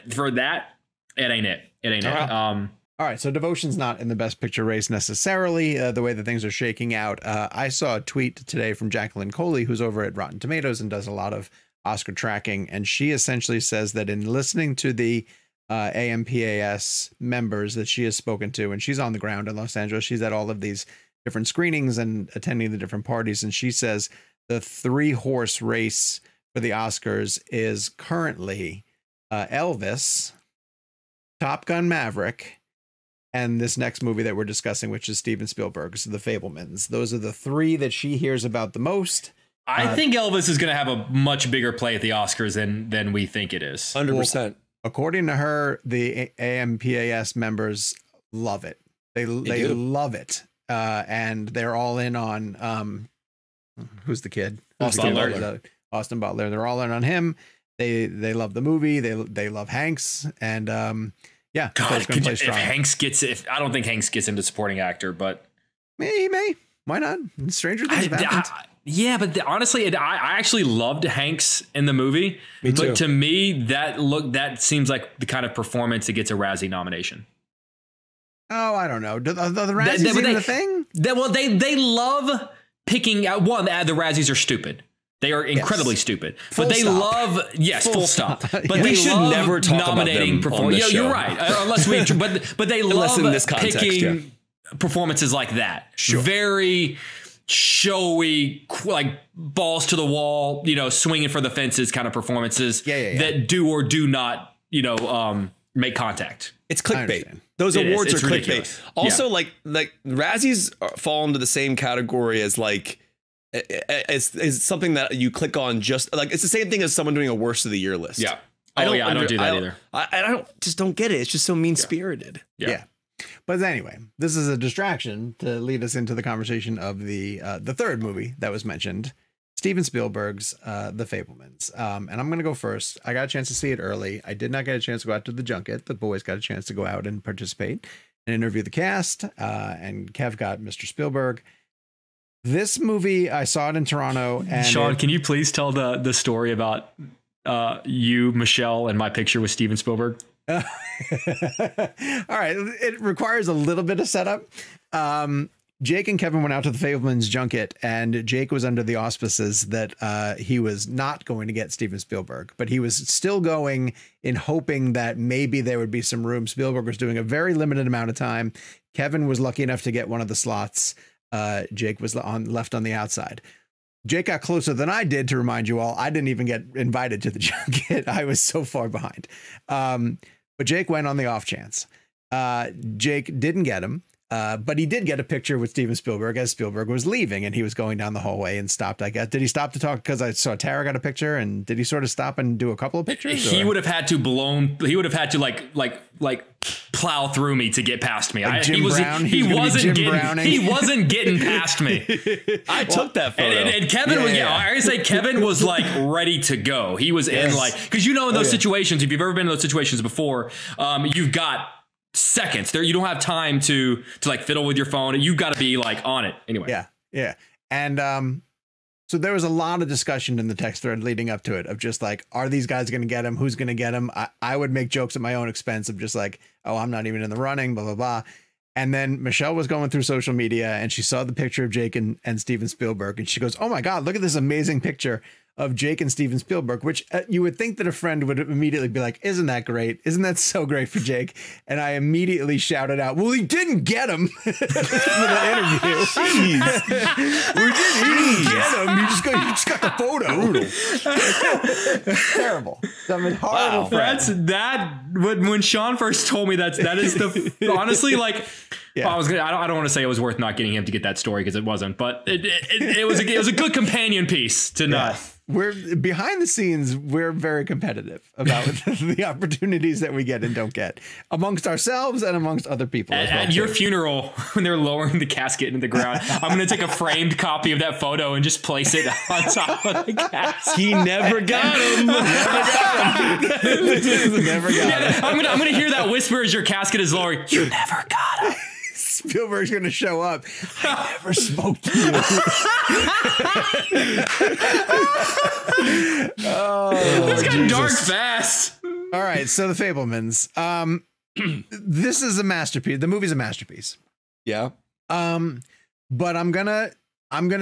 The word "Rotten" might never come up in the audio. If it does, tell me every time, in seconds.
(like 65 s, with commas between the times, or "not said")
10 s.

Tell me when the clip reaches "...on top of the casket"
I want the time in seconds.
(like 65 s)
279 s.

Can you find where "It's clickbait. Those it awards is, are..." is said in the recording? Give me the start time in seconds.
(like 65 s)
106 s.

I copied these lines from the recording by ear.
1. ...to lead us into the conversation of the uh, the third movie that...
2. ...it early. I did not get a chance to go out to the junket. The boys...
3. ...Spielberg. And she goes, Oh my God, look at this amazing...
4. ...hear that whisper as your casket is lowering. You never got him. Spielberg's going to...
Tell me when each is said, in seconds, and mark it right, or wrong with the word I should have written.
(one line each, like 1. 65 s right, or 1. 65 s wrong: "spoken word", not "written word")
1. 125 s right
2. 133 s right
3. 232 s right
4. 285 s right.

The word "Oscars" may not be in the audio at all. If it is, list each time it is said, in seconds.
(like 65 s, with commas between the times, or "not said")
11 s, 26 s, 42 s.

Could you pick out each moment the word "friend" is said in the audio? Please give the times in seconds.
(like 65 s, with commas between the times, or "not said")
237 s, 253 s.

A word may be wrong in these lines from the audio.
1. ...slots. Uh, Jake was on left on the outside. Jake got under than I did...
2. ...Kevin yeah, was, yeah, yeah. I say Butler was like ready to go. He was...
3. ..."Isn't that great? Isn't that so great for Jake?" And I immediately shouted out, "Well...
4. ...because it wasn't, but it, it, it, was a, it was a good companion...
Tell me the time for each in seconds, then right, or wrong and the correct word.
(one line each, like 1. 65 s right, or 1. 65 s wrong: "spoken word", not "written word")
1. 170 s wrong: "closer", not "under"
2. 203 s wrong: "Kevin", not "Butler"
3. 239 s right
4. 261 s right.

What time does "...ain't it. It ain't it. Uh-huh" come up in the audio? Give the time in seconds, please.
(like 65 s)
1 s.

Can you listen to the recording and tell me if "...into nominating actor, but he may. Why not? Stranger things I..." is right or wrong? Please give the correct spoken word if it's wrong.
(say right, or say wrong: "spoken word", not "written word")
wrong: "supporting", not "nominating".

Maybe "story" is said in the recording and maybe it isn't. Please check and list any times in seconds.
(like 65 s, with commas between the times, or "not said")
146 s, 261 s.